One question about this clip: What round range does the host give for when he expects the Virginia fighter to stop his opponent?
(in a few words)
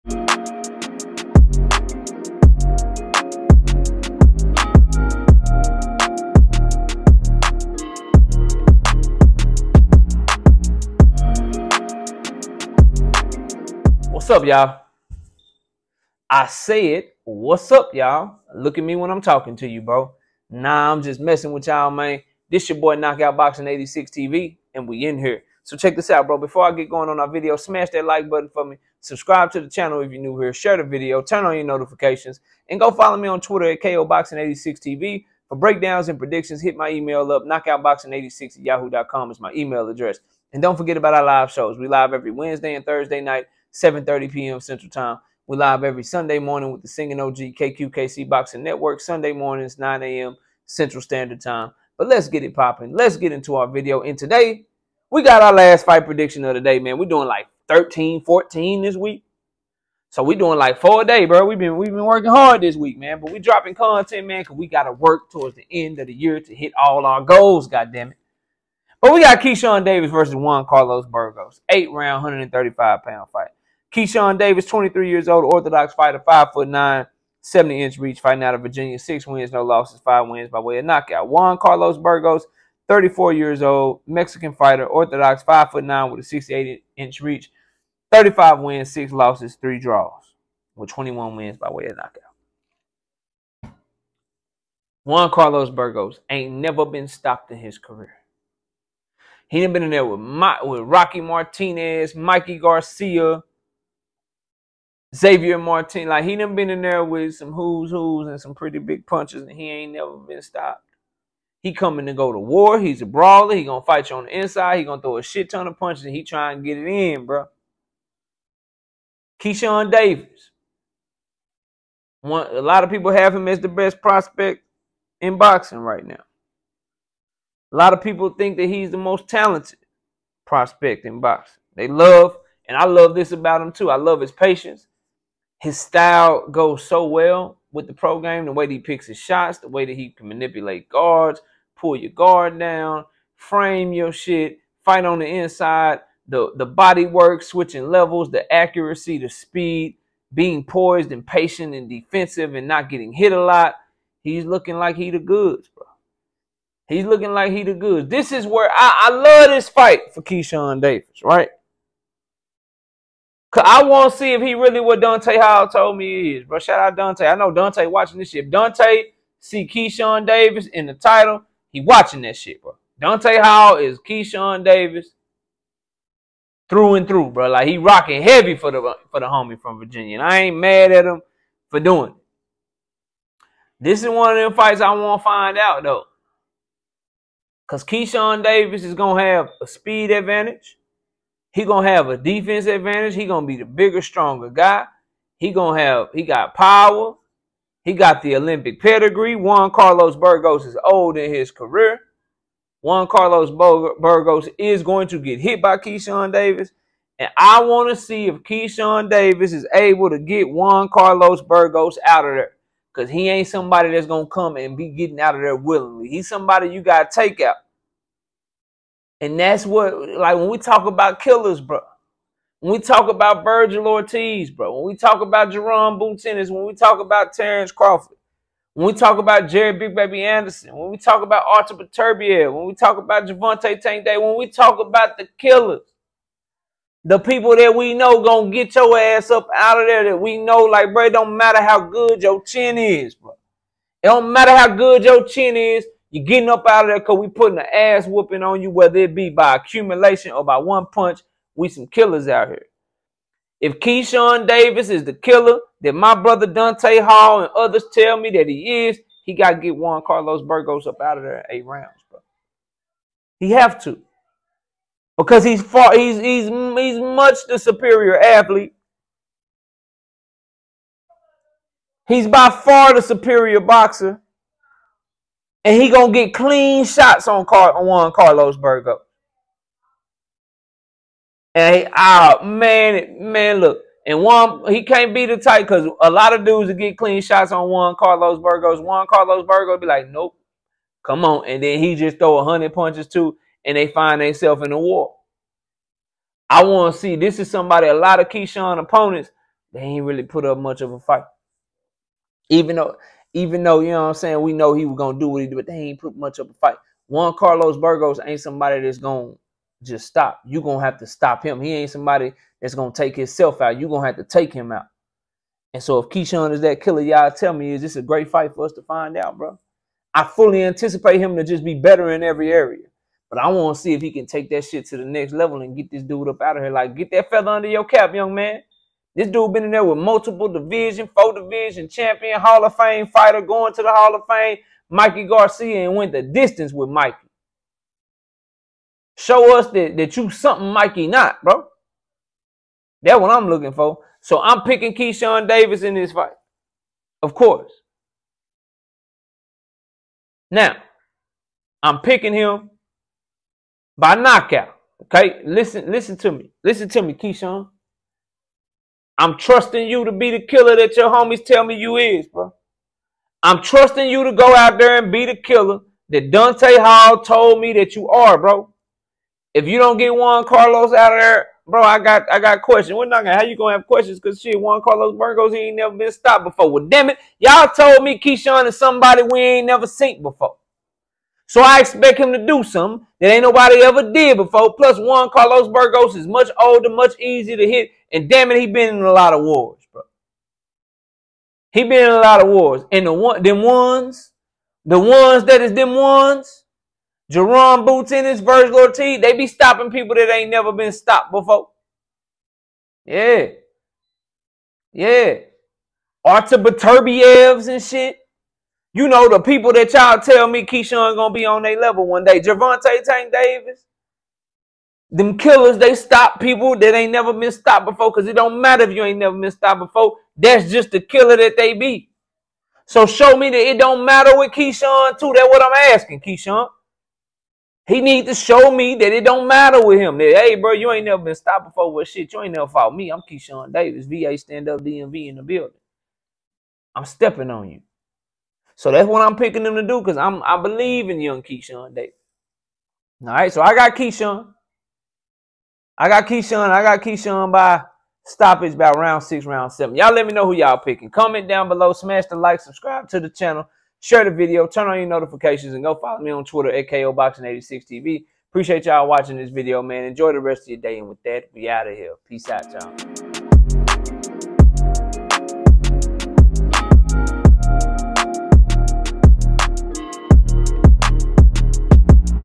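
Round 6 or 7.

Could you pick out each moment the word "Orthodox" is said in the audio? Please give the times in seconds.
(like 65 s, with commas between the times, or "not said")
75 s, 84 s.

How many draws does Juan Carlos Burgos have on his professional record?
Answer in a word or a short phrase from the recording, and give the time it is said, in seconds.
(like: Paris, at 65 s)
3, at 89 s.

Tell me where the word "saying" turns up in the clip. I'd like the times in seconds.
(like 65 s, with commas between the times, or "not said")
304 s.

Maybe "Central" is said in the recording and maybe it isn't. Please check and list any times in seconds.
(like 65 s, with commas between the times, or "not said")
44 s, 50 s.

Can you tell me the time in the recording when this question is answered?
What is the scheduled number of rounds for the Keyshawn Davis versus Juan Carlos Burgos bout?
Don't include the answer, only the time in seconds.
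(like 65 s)
71 s.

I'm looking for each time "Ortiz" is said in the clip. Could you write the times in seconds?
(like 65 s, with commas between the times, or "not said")
223 s, 398 s.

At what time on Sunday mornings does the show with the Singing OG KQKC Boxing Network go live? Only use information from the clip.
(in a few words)
9 a.m.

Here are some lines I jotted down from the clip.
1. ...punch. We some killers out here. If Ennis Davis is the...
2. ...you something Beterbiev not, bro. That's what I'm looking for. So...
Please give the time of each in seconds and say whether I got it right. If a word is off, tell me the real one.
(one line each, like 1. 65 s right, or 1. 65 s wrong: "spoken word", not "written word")
1. 250 s wrong: "Keyshawn", not "Ennis"
2. 340 s wrong: "Mikey", not "Beterbiev".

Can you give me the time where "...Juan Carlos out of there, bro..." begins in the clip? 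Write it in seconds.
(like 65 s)
370 s.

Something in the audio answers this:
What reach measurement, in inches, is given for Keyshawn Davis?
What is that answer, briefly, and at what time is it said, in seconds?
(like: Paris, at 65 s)
70 inches, at 77 s.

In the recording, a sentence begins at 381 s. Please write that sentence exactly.
So I expect him to do something that ain't nobody ever did before.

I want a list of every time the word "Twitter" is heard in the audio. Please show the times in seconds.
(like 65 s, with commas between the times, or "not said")
33 s, 456 s.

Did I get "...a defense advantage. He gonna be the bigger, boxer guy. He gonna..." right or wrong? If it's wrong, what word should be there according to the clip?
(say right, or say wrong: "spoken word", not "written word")
wrong: "stronger", not "boxer".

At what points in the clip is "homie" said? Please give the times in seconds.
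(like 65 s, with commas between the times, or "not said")
179 s, 361 s.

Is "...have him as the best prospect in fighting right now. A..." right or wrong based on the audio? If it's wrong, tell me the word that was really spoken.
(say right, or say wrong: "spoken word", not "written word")
wrong: "boxing", not "fighting".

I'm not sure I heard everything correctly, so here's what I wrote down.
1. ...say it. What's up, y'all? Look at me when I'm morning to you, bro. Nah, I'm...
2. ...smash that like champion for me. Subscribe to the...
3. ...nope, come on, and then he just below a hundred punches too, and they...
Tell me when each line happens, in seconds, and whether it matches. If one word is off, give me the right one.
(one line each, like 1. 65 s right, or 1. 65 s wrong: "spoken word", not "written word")
1. 16 s wrong: "talking", not "morning"
2. 27 s wrong: "button", not "champion"
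3. 290 s wrong: "throw", not "below".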